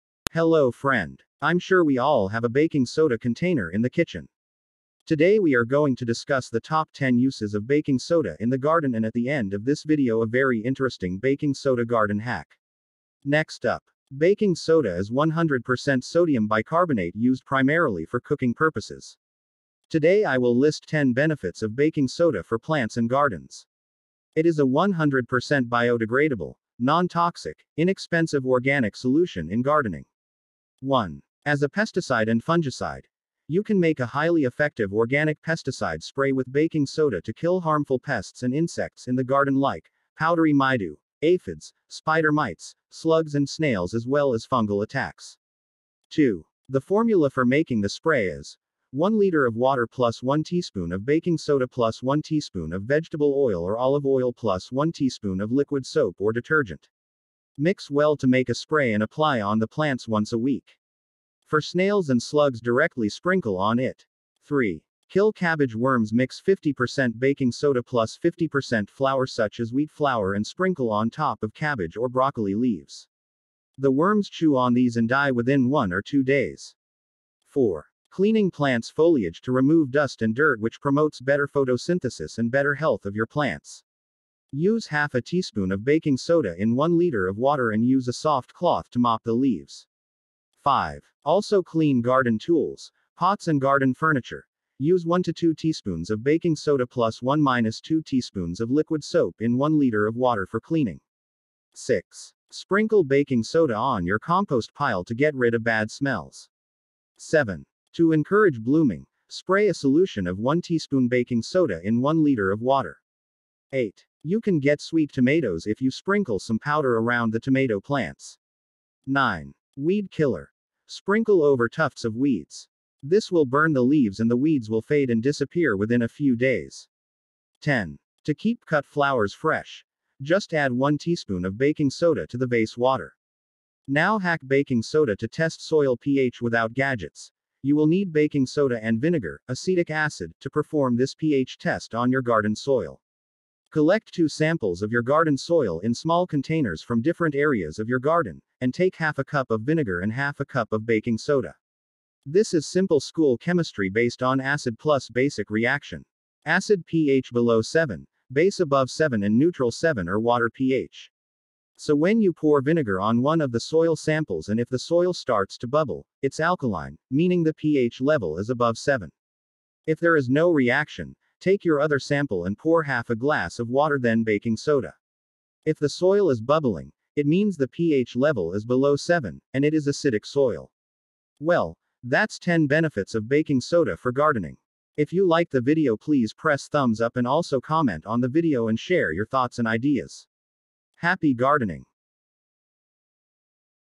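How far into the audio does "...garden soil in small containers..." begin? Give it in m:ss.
2:25.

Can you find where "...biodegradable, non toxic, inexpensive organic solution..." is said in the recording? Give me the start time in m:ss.
0:25.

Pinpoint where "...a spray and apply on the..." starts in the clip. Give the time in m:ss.
0:58.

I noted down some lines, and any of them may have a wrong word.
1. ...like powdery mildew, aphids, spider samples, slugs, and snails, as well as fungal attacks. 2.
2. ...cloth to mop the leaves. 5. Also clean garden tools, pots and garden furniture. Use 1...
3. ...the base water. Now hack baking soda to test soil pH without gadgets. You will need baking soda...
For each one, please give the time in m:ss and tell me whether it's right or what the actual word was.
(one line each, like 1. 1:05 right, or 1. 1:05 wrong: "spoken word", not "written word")
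1. 0:39 wrong: "mites", not "samples"
2. 1:28 right
3. 2:12 right.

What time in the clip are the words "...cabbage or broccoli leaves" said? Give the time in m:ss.
1:11.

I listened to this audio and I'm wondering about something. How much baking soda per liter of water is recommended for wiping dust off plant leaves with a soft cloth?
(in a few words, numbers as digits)
half a teaspoon.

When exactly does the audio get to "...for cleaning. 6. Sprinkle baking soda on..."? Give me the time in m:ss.
1:40.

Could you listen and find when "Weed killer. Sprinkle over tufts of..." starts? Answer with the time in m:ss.
1:59.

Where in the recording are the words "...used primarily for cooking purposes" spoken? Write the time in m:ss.
0:17.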